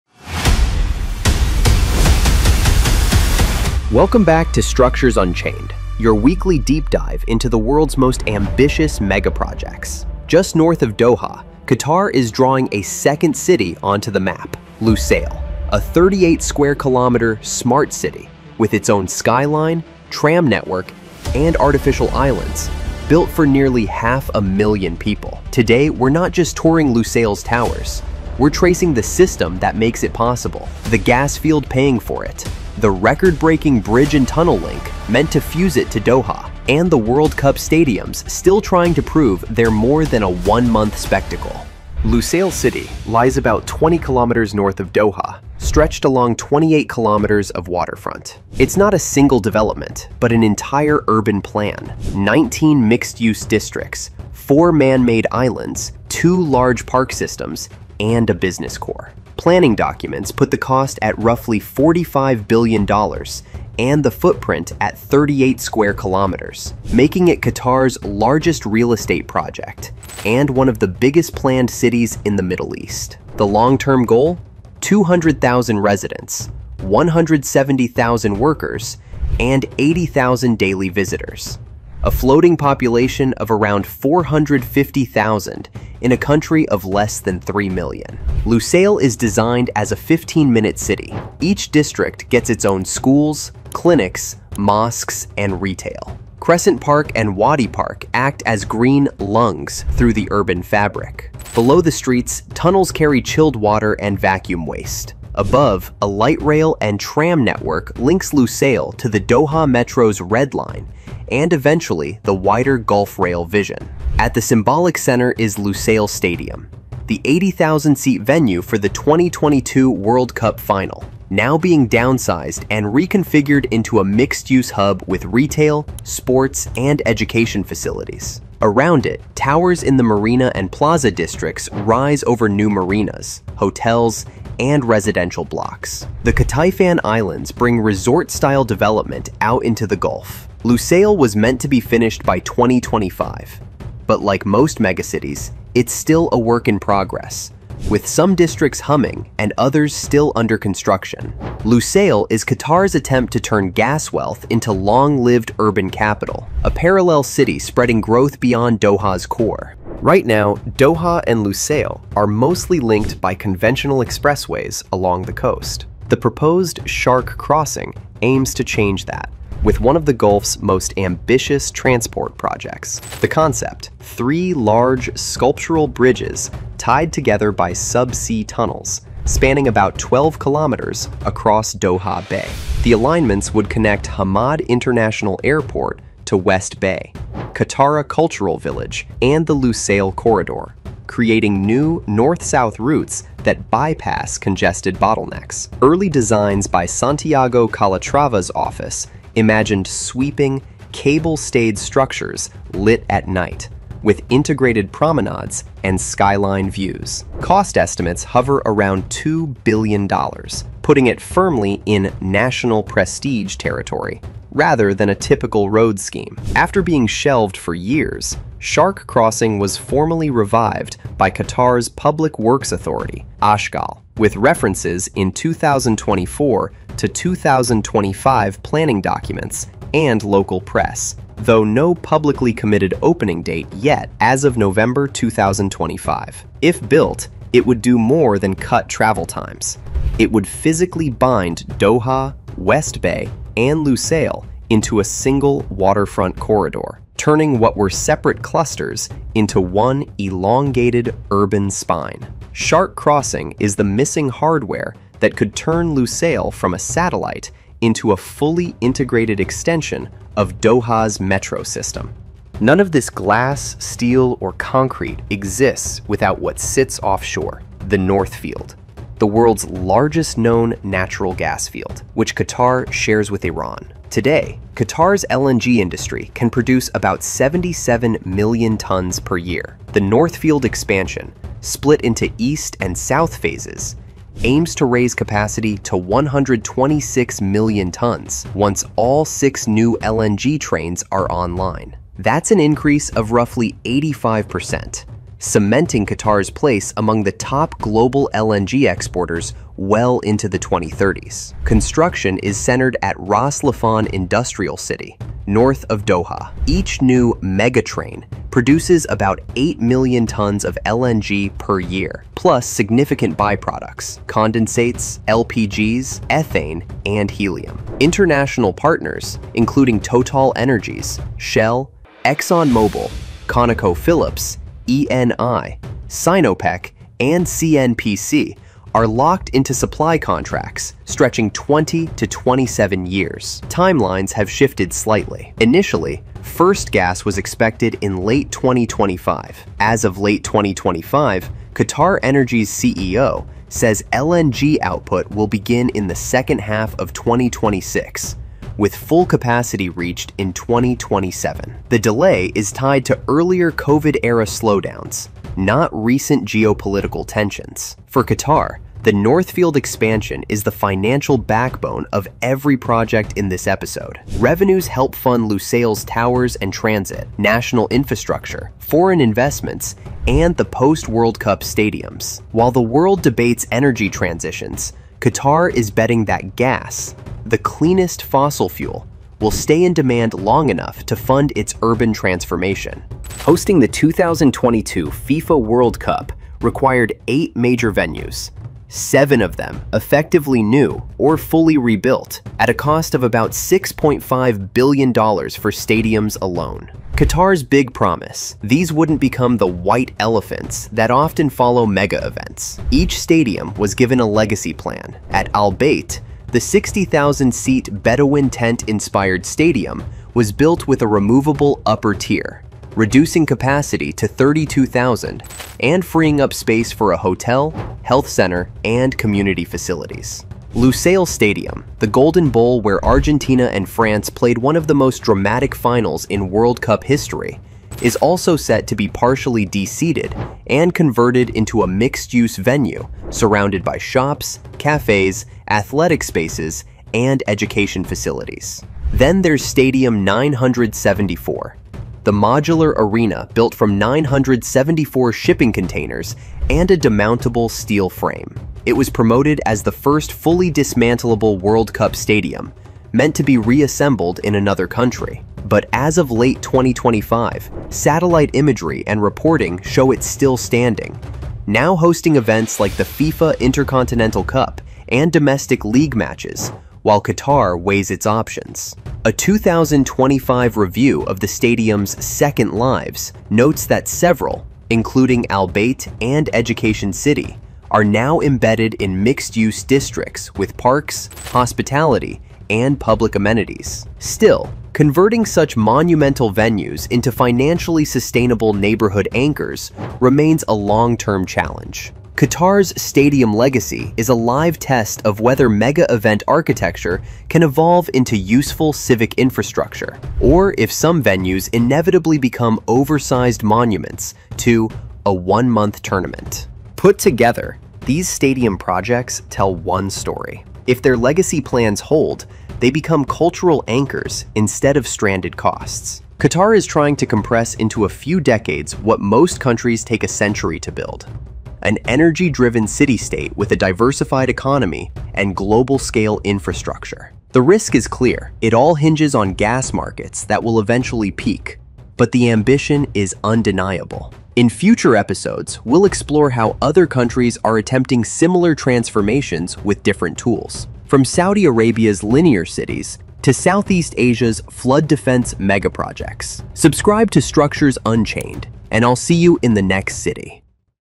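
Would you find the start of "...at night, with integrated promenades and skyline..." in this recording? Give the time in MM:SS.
03:23.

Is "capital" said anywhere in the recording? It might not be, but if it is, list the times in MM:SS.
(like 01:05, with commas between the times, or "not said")
02:35.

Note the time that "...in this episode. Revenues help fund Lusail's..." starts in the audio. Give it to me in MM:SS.
06:03.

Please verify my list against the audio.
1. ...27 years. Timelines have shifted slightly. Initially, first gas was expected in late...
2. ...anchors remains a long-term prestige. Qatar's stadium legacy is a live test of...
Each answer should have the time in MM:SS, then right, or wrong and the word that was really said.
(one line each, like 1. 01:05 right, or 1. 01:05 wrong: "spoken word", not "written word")
1. 05:32 right
2. 08:09 wrong: "challenge", not "prestige".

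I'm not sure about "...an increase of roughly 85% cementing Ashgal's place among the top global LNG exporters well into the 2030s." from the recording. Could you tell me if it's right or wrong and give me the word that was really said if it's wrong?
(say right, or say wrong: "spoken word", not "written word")
wrong: "Qatar", not "Ashgal".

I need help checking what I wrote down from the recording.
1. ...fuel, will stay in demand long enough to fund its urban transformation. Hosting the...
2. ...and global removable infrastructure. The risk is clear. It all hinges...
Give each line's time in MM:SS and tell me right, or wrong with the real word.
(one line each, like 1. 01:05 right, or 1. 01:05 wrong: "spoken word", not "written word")
1. 06:18 right
2. 08:45 wrong: "scale", not "removable".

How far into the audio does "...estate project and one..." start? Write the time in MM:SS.
01:08.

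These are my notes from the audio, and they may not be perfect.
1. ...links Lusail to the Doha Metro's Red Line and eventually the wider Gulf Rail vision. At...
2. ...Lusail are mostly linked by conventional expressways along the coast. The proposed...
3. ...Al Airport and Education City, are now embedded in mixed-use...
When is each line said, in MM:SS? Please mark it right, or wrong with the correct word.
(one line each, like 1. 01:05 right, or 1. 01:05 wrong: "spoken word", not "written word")
1. 01:47 right
2. 02:41 right
3. 07:55 wrong: "Bayt", not "Airport".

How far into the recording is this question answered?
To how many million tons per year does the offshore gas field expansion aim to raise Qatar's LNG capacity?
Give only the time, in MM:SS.
04:45.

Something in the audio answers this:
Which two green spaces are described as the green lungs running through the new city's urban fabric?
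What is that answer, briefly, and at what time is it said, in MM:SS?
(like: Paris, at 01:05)
Crescent Park and Wadi Park, at 01:36.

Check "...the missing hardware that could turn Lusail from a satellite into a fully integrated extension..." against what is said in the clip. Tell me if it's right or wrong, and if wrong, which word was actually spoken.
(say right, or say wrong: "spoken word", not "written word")
right.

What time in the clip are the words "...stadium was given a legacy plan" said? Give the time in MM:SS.
06:43.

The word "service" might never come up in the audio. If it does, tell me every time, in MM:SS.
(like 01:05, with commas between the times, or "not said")
not said.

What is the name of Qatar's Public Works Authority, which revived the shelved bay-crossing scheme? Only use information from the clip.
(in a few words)
Ashgal.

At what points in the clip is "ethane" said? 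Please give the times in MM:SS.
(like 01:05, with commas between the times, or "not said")
05:16.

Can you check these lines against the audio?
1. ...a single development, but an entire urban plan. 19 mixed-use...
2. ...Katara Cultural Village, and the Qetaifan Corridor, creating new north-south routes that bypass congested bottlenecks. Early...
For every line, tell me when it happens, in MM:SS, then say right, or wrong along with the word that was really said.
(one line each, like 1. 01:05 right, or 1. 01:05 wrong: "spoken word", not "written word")
1. 00:48 right
2. 03:07 wrong: "Lusail", not "Qetaifan".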